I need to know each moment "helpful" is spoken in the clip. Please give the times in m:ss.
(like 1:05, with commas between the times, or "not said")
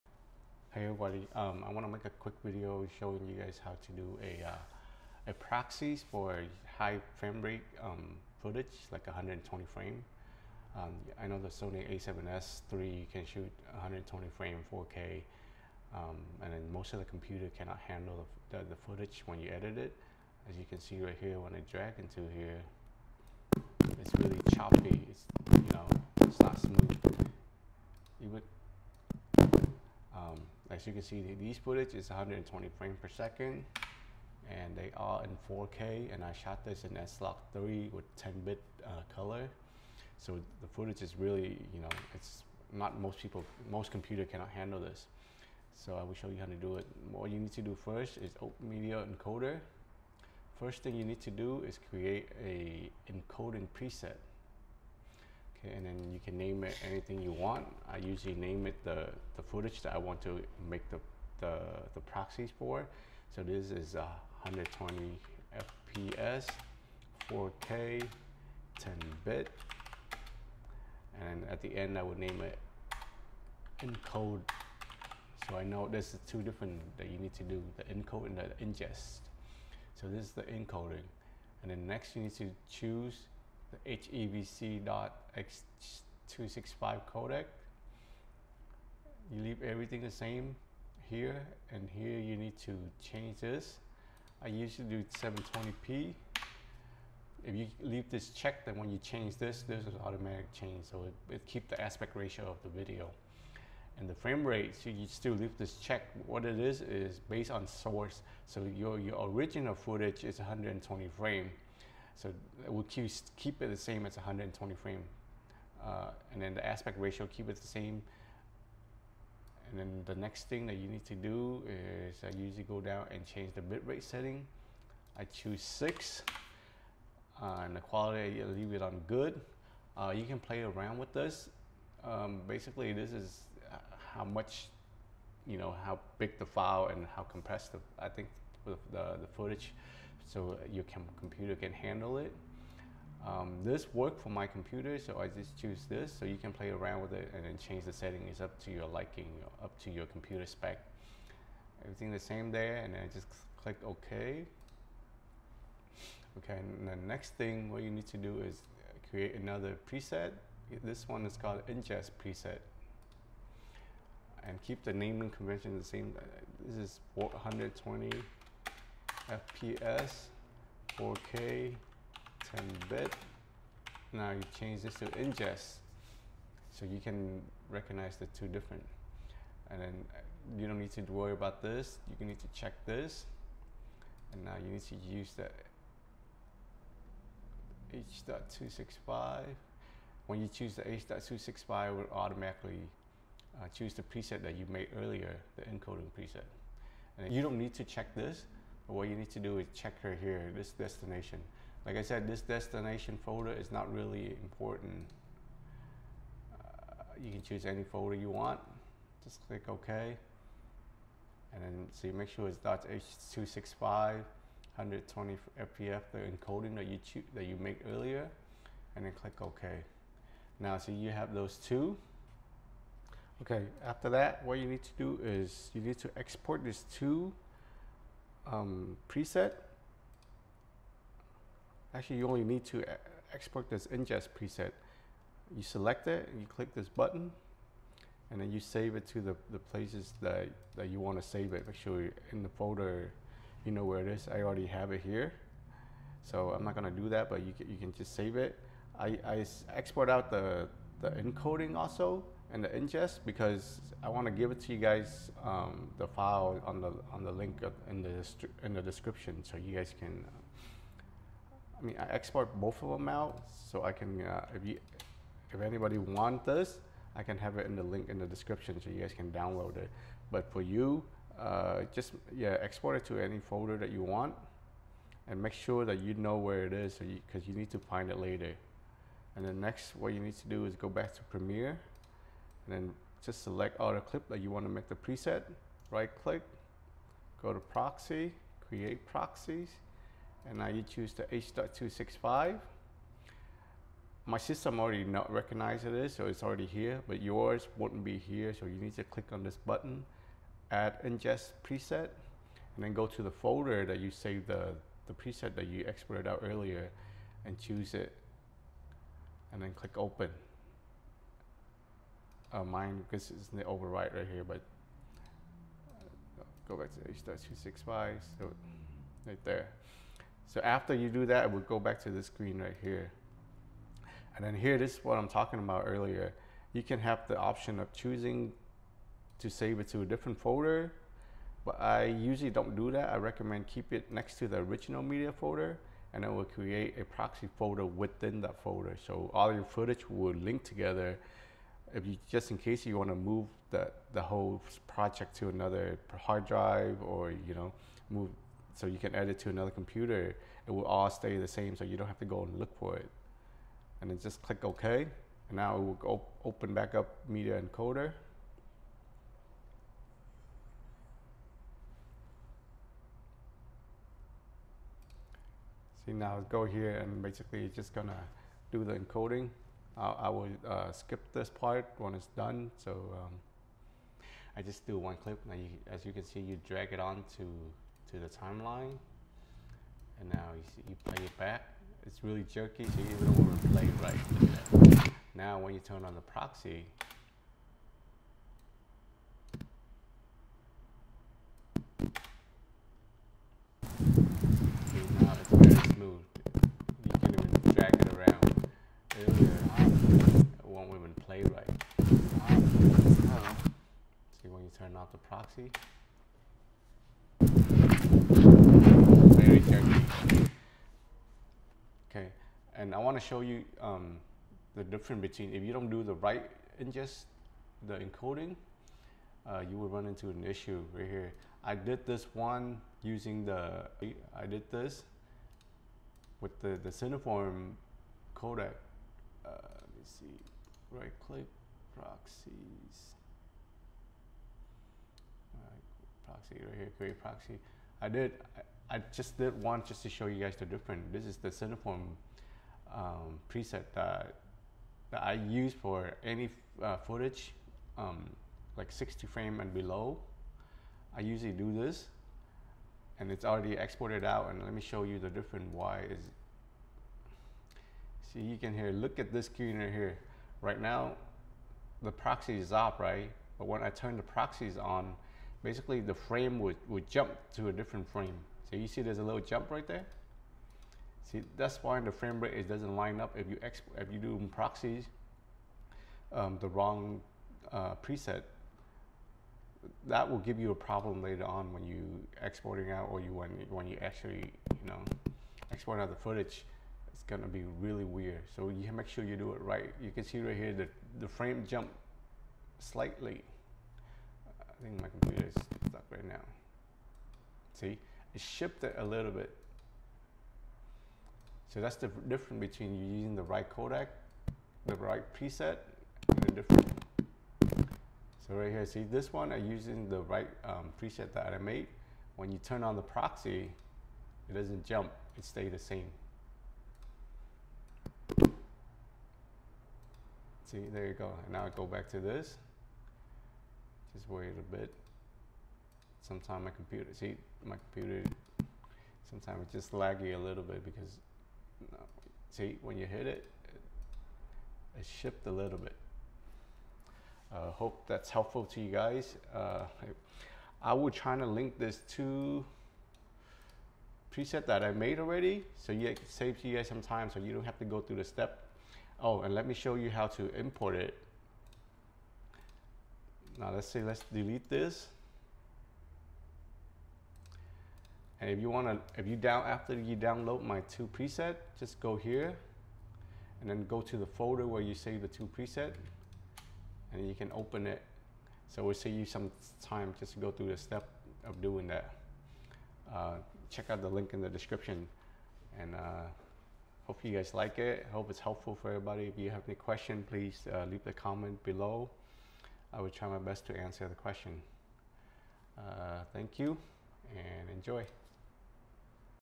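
8:58, 9:38.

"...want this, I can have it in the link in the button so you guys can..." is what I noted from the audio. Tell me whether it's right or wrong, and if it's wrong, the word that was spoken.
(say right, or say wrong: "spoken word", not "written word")
wrong: "description", not "button".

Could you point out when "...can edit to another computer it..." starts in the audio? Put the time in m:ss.
5:48.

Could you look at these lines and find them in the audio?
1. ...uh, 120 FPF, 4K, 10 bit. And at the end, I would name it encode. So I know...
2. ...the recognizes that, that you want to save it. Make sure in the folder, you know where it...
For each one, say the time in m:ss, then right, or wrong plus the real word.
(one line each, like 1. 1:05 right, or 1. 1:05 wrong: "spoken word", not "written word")
1. 1:03 wrong: "FPS", not "FPF"
2. 3:59 wrong: "places", not "recognizes".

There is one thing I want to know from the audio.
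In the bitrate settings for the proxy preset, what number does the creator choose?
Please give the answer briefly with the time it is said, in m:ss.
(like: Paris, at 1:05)
6, at 2:05.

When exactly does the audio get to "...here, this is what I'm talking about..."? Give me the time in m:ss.
5:24.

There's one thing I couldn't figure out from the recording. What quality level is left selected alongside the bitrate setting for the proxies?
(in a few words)
Good.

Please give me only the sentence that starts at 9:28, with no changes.
So we'll save you some time just to go through the step of doing that.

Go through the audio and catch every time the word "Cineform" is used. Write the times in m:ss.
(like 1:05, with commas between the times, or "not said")
7:06, 7:21.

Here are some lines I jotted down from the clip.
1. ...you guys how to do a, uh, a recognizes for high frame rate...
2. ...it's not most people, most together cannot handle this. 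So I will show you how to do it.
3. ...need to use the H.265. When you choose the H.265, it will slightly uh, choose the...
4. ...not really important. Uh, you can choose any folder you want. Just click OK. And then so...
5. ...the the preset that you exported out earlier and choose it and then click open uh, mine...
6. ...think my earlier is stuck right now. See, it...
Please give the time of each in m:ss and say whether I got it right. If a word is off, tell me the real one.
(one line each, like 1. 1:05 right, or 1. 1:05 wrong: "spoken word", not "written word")
1. 0:03 wrong: "proxies", not "recognizes"
2. 0:42 wrong: "computer", not "together"
3. 3:04 wrong: "automatically", not "slightly"
4. 3:23 right
5. 5:04 right
6. 8:14 wrong: "computer", not "earlier".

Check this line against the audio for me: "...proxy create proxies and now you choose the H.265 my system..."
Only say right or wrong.
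right.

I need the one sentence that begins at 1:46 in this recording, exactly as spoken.
What it is, is based on source.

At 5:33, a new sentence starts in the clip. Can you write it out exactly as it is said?
I recommend keep it next to the original media folder and it will create a proxy folder within that folder.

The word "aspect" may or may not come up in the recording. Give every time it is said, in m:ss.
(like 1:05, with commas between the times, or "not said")
1:41, 1:56.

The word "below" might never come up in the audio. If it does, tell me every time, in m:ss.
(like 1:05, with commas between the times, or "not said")
7:29, 9:41.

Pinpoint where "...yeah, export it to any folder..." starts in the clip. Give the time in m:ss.
4:32.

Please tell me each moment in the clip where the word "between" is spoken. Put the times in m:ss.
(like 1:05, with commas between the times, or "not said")
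6:55, 8:22.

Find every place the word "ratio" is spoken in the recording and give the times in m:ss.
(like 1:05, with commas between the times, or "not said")
1:42, 1:56.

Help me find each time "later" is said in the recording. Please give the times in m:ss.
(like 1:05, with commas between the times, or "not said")
4:38, 8:01.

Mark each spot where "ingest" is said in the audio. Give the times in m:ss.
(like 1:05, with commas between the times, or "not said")
1:18, 2:41, 2:55, 3:53, 4:12, 5:01, 6:56.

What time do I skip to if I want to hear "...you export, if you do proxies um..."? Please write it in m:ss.
7:53.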